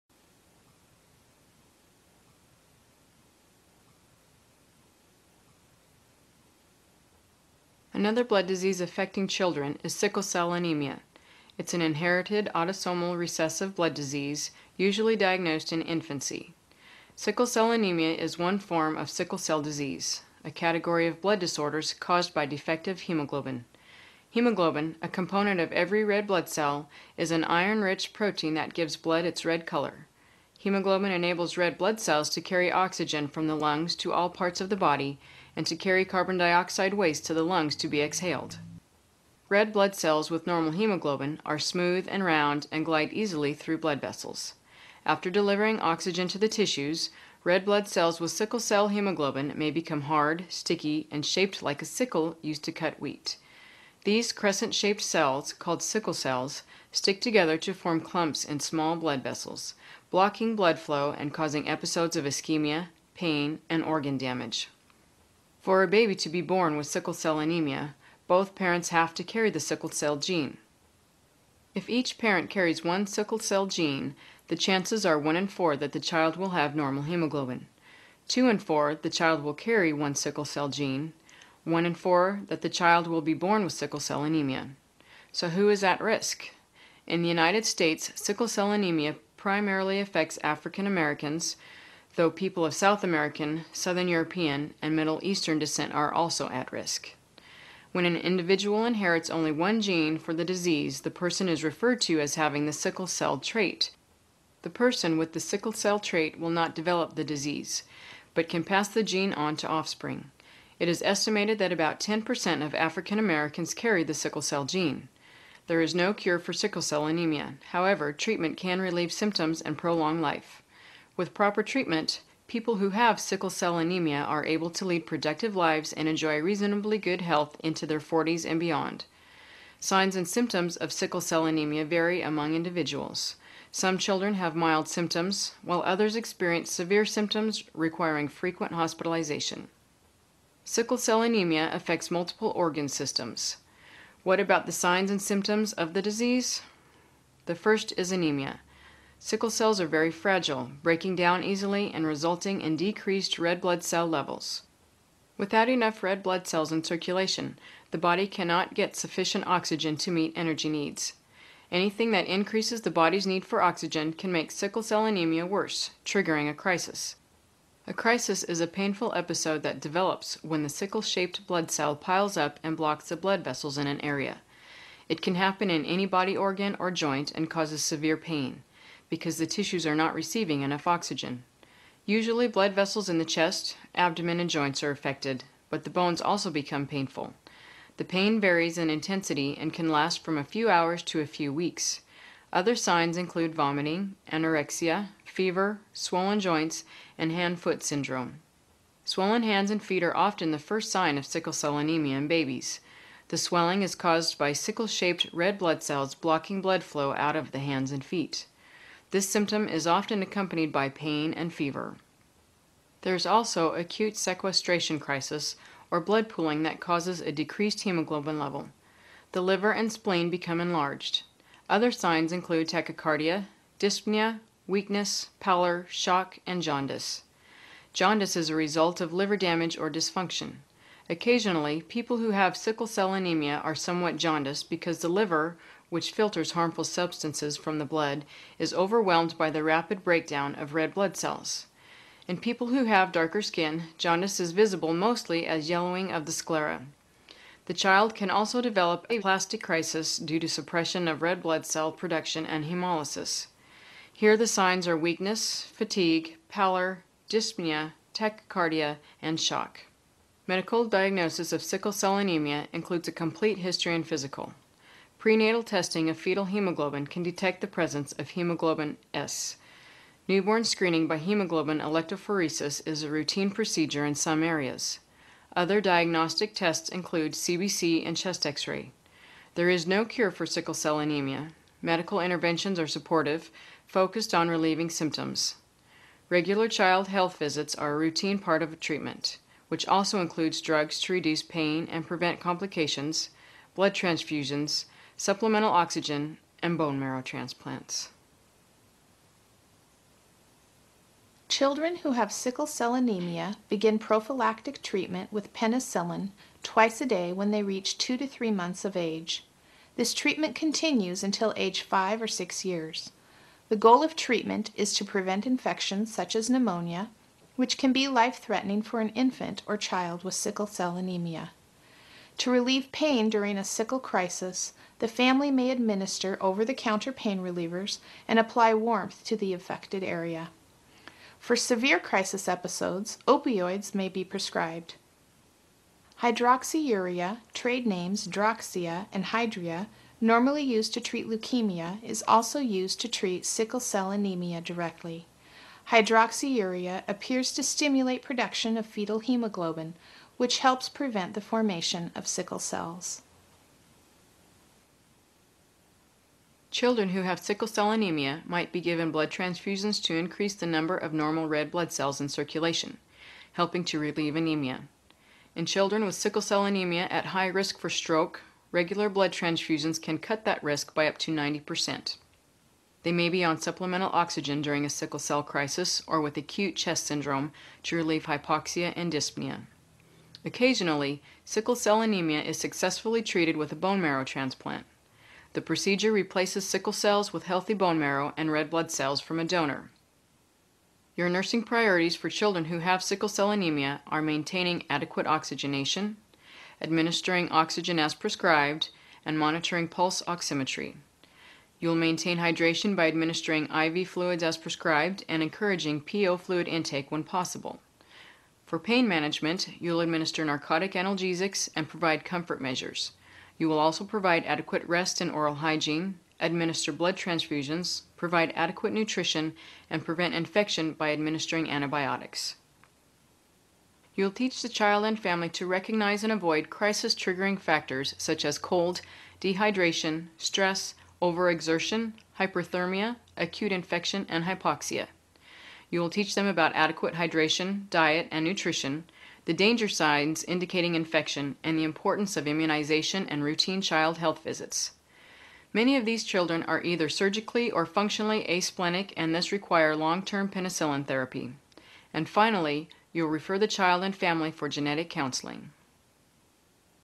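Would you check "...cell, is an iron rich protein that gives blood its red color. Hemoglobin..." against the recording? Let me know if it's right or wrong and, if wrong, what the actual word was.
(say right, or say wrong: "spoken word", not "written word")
right.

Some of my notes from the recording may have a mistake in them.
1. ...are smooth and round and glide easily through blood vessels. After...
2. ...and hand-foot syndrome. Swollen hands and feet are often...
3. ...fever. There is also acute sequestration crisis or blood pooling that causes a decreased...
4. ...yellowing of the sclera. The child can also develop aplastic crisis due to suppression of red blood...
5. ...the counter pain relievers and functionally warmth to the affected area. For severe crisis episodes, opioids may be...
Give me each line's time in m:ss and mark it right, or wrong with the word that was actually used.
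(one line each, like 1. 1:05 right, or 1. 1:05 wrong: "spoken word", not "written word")
1. 0:41 right
2. 3:17 right
3. 3:31 right
4. 4:05 right
5. 5:26 wrong: "apply", not "functionally".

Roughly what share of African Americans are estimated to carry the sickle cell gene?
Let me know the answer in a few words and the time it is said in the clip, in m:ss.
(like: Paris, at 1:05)
10%, at 1:51.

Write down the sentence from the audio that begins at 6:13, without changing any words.
They may be on supplemental oxygen during a sickle cell crisis or with acute chest syndrome to relieve hypoxia and dyspnea.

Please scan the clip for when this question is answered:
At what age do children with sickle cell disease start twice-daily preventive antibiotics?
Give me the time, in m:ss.
5:07.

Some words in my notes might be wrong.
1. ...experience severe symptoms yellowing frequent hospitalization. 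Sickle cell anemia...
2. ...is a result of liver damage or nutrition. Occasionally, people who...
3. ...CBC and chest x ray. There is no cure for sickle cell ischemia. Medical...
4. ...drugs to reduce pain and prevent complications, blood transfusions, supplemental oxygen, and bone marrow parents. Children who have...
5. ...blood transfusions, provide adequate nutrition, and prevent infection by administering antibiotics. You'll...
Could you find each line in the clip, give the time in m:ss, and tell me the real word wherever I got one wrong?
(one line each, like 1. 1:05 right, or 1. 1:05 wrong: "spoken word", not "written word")
1. 2:16 wrong: "requiring", not "yellowing"
2. 3:48 wrong: "dysfunction", not "nutrition"
3. 4:37 wrong: "anemia", not "ischemia"
4. 4:50 wrong: "transplants", not "parents"
5. 6:56 right.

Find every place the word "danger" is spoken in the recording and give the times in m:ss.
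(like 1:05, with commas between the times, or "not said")
7:19.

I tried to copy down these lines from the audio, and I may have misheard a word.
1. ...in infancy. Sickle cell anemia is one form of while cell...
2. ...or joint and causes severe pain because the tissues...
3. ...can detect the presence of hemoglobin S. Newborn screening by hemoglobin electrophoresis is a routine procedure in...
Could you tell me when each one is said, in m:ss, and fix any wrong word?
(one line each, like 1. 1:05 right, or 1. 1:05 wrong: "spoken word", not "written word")
1. 0:15 wrong: "sickle", not "while"
2. 2:56 right
3. 4:27 right.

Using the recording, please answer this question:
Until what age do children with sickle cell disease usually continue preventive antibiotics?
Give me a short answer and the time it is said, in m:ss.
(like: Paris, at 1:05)
5 or 6 years, at 5:11.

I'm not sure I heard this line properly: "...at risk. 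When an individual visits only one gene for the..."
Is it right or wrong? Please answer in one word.
wrong.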